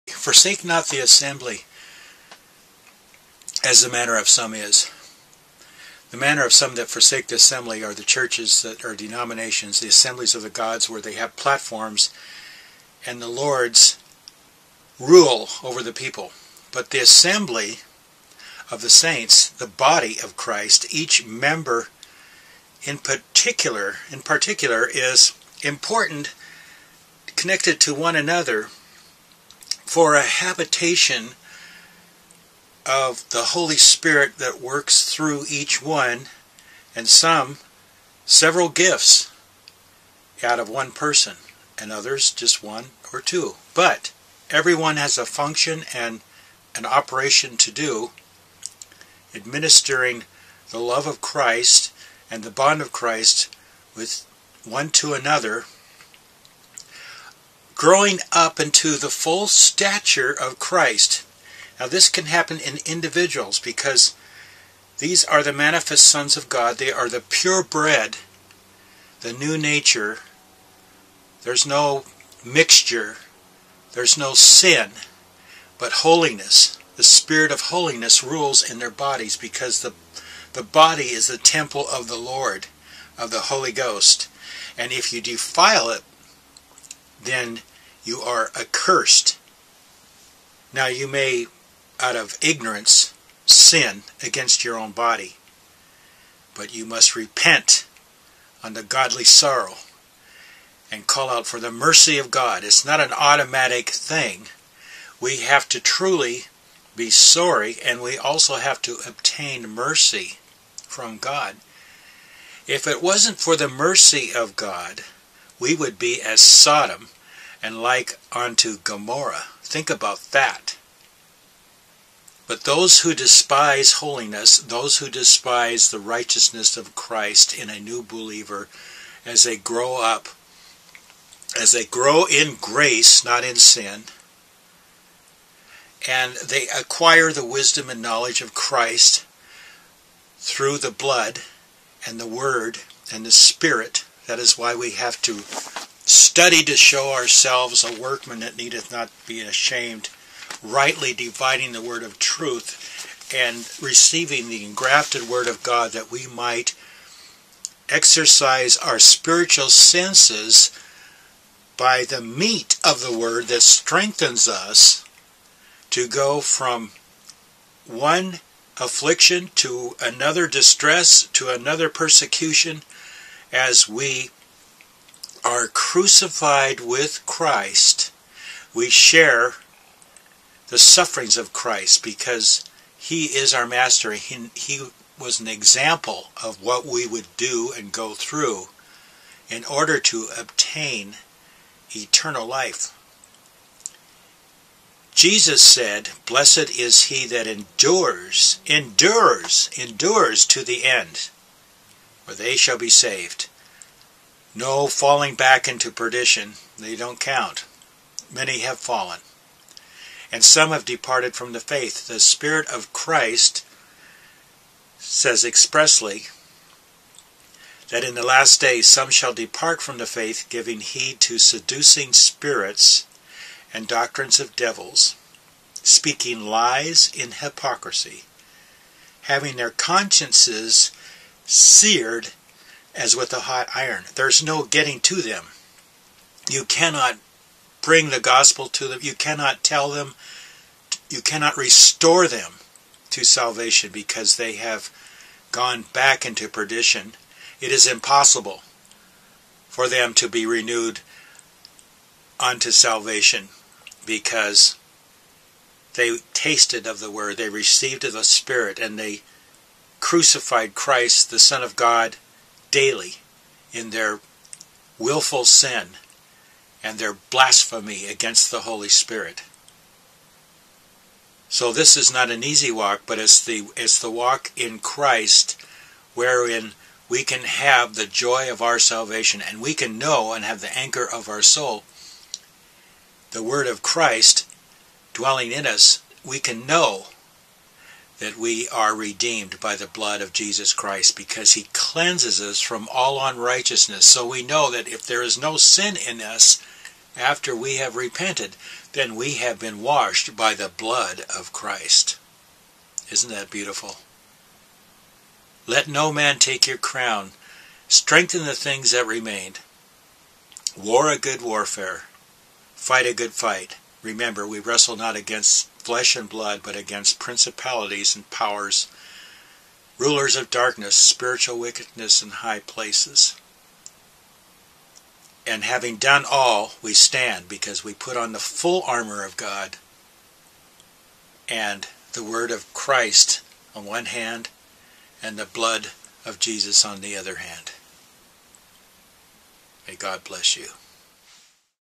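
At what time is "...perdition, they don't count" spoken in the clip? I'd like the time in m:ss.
3:25.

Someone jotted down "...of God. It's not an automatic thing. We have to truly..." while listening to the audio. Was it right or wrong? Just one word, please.
right.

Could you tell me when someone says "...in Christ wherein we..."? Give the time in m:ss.
4:34.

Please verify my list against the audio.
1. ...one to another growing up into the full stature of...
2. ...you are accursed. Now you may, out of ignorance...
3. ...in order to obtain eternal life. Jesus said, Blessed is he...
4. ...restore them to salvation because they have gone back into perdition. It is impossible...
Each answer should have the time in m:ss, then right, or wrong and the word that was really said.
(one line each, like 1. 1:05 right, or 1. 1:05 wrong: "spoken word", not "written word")
1. 0:54 right
2. 1:28 right
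3. 3:09 right
4. 4:01 right.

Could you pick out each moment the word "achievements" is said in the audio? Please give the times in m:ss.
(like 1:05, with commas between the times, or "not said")
not said.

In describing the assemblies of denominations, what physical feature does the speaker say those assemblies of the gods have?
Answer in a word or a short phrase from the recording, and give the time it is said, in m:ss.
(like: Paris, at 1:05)
Platforms, at 0:11.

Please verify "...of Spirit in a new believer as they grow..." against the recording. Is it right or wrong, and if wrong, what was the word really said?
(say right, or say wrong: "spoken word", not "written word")
wrong: "Christ", not "Spirit".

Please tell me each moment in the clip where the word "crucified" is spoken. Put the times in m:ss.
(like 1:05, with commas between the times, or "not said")
2:55, 4:19.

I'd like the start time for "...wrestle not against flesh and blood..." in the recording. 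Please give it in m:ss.
5:14.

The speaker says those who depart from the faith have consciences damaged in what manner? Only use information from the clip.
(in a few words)
Seared as with a hot iron.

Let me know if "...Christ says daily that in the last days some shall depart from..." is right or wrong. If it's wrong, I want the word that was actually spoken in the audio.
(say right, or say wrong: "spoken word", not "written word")
wrong: "expressly", not "daily".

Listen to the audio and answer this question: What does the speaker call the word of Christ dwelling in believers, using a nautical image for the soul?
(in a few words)
Anchor of our soul.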